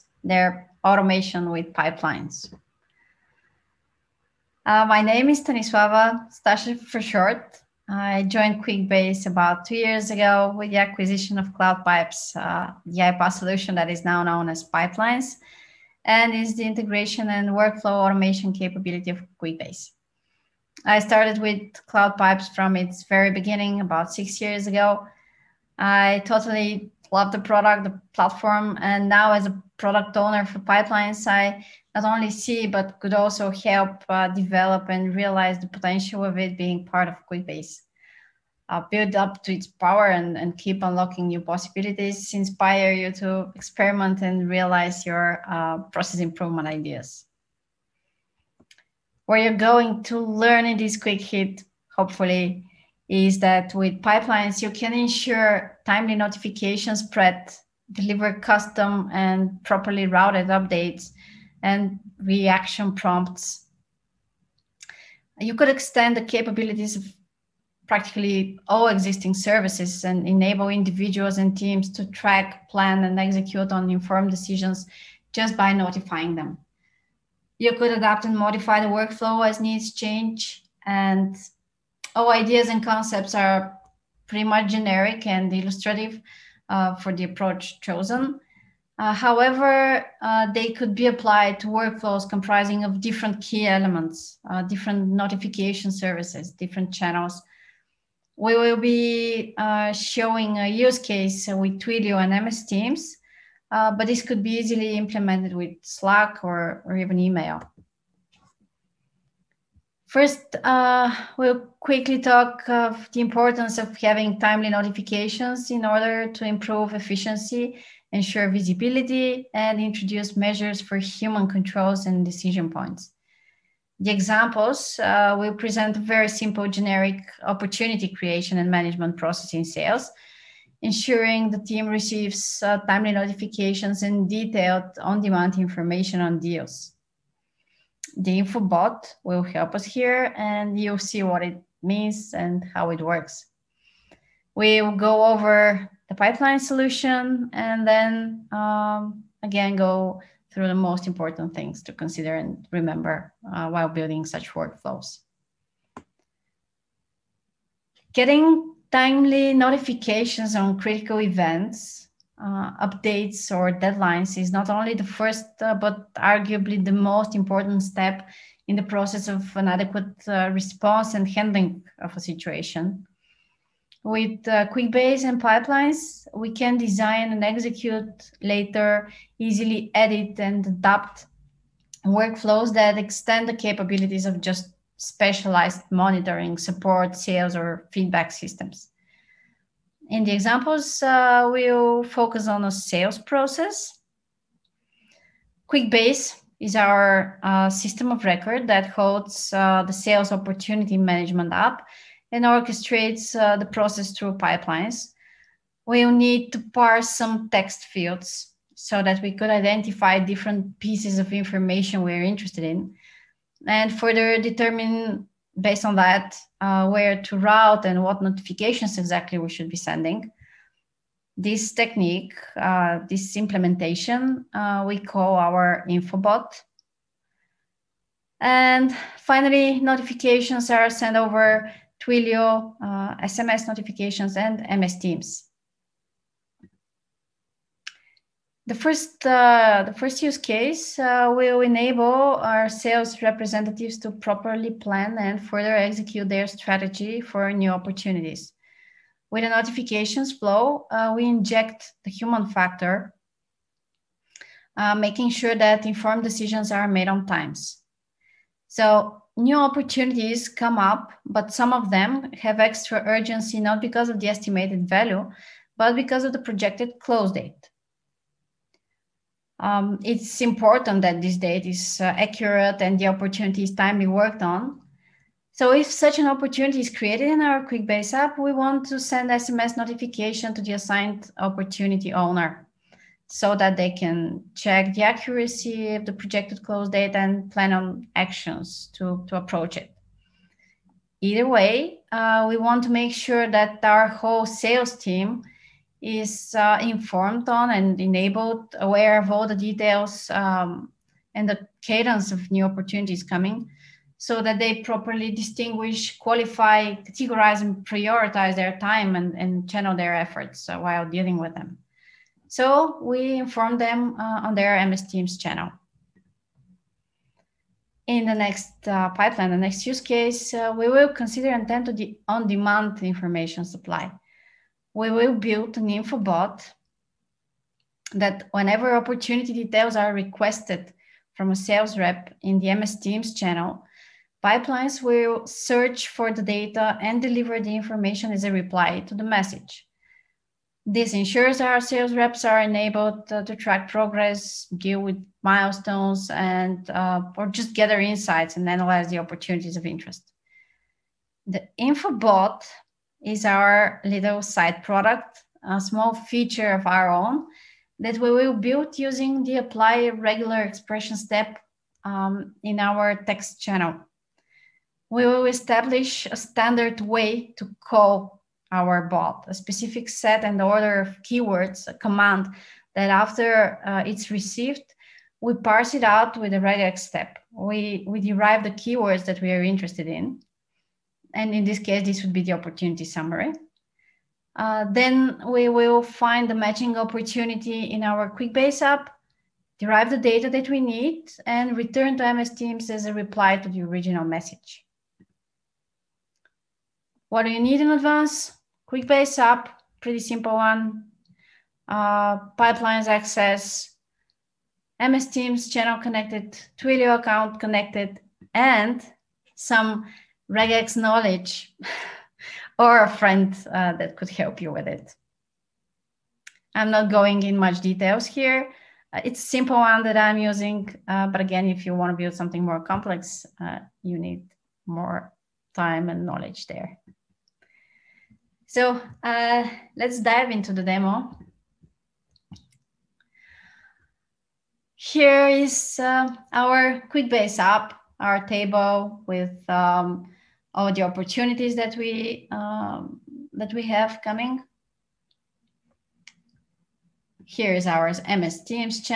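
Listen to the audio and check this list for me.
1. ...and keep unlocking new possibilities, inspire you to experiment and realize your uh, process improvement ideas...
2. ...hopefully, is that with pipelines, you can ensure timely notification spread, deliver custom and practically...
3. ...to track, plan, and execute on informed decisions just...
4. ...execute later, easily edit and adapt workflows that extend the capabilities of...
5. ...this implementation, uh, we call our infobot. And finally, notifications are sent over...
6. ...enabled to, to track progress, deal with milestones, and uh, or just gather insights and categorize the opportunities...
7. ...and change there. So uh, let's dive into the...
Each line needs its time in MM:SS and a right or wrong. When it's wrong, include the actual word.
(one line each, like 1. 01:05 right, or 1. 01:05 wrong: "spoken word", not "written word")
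1. 00:40 right
2. 00:51 wrong: "properly", not "practically"
3. 01:11 right
4. 02:57 right
5. 03:43 right
6. 05:42 wrong: "analyze", not "categorize"
7. 07:06 wrong: "knowledge", not "change".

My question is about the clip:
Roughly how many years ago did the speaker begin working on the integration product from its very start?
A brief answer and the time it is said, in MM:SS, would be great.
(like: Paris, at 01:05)
6, at 00:24.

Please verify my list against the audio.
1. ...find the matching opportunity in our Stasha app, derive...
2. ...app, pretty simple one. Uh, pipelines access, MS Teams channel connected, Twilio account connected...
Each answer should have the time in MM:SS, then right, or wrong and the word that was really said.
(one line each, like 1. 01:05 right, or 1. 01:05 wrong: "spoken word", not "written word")
1. 06:26 wrong: "QuickBase", not "Stasha"
2. 06:39 right.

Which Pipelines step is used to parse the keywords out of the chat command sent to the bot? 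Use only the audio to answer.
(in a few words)
apply regular expression.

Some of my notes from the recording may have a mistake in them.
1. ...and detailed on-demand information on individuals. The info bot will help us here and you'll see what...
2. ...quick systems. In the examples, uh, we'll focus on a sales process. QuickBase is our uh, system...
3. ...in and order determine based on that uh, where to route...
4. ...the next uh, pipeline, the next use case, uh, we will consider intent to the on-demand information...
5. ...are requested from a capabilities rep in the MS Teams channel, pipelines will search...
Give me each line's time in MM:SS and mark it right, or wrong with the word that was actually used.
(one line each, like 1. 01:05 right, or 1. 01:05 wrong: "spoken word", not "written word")
1. 02:14 wrong: "deals", not "individuals"
2. 03:07 wrong: "feedback", not "quick"
3. 03:32 wrong: "further", not "order"
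4. 05:18 right
5. 05:29 wrong: "sales", not "capabilities".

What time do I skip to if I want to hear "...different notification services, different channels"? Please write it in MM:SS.
01:34.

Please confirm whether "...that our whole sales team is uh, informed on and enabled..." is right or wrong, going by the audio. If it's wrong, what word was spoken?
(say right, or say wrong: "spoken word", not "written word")
right.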